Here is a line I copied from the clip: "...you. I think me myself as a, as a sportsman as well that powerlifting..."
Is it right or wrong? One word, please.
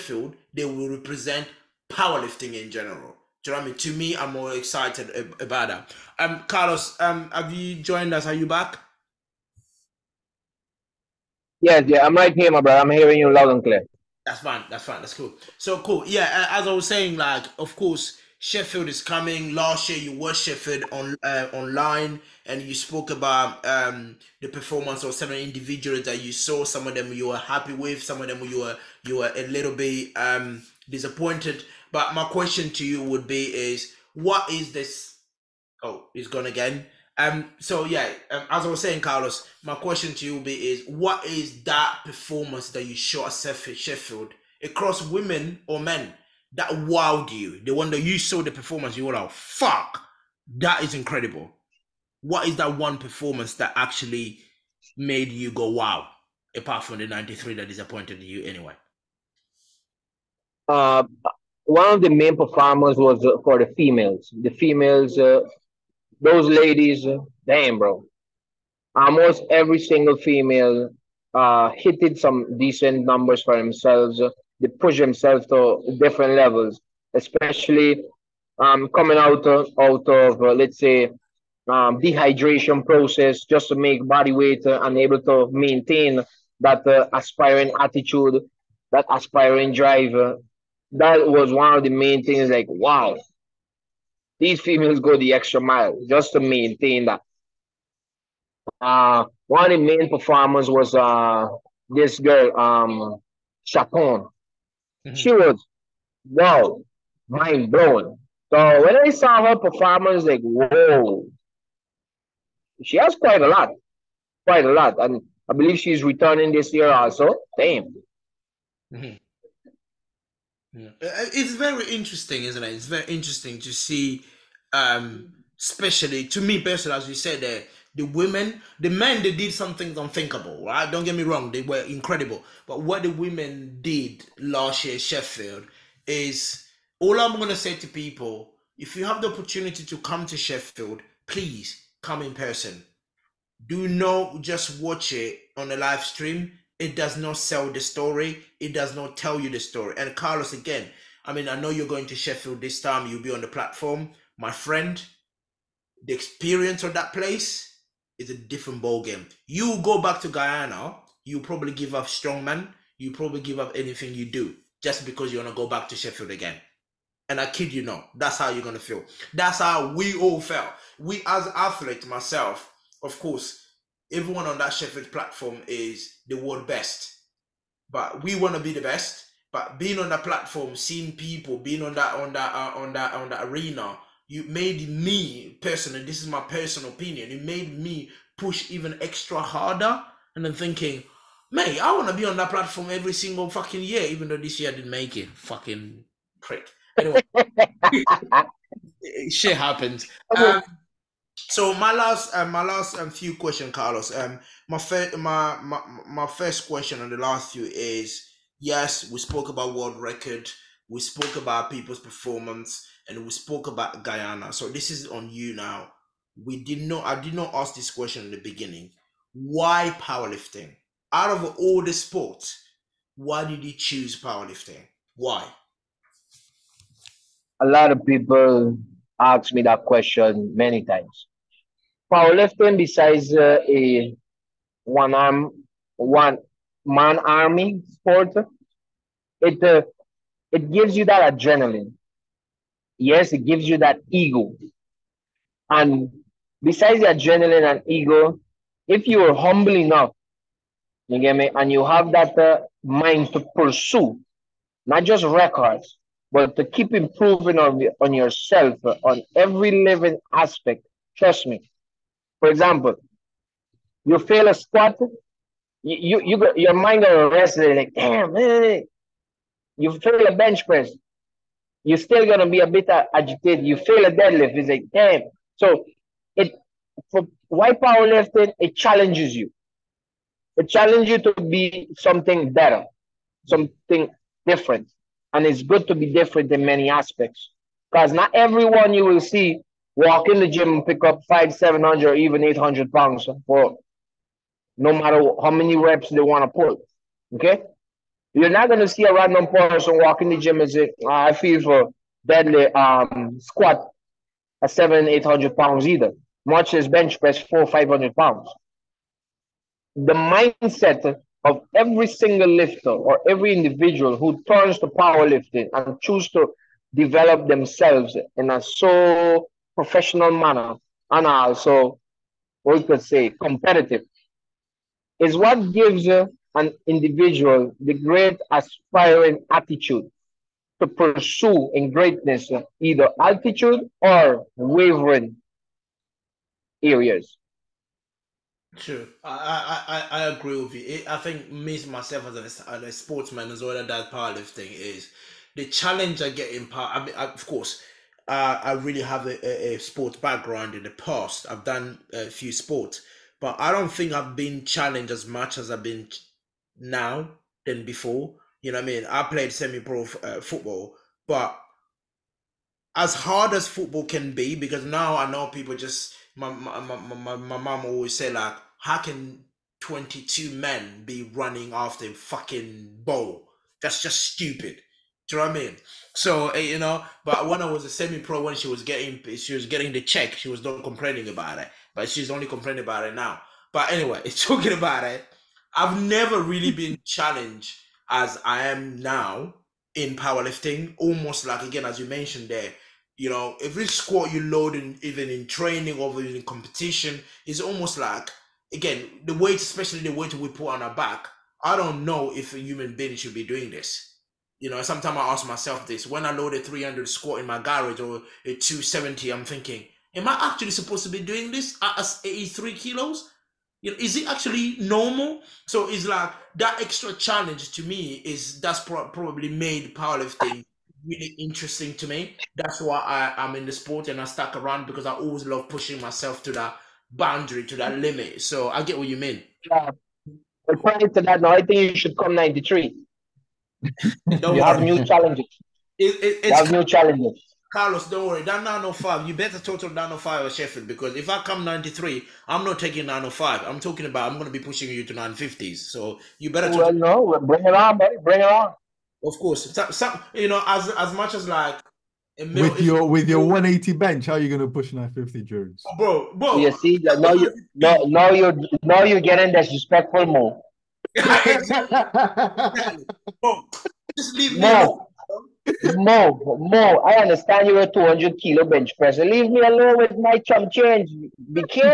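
right.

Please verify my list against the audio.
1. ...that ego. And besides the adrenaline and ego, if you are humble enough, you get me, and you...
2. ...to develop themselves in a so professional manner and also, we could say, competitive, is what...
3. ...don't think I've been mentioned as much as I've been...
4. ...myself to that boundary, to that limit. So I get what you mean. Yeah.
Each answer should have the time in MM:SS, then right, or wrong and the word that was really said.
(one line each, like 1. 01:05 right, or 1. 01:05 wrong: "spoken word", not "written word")
1. 04:03 right
2. 05:16 right
3. 05:53 wrong: "challenged", not "mentioned"
4. 07:05 right.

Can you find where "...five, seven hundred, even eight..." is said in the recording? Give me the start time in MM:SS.
04:51.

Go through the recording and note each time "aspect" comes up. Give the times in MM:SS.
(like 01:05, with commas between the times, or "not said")
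04:20, 04:46.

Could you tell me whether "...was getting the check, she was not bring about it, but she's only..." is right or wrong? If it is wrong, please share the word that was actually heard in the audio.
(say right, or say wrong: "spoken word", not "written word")
wrong: "complaining", not "bring".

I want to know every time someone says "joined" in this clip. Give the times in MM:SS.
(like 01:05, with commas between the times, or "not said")
00:07.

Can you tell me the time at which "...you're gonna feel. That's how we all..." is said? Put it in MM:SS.
02:48.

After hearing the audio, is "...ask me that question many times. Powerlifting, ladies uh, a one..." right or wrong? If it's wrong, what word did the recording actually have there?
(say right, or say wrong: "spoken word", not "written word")
wrong: "besides", not "ladies".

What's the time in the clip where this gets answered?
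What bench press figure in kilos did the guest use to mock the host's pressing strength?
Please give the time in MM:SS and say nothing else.
07:33.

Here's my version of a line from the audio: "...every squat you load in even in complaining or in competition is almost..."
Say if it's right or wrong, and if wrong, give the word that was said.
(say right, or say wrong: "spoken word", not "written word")
wrong: "training", not "complaining".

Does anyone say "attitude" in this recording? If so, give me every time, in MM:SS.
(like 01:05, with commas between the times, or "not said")
01:27, 05:29.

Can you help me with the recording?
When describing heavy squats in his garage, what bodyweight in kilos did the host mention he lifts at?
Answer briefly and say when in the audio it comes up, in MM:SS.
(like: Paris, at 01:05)
83 kilos, at 06:52.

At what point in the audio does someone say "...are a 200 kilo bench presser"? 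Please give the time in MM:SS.
07:47.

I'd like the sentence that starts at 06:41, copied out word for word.
I don't know if a human being should be doing this.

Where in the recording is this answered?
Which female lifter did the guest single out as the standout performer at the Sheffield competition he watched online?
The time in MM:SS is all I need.
01:43.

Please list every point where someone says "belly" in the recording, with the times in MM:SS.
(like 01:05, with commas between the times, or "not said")
not said.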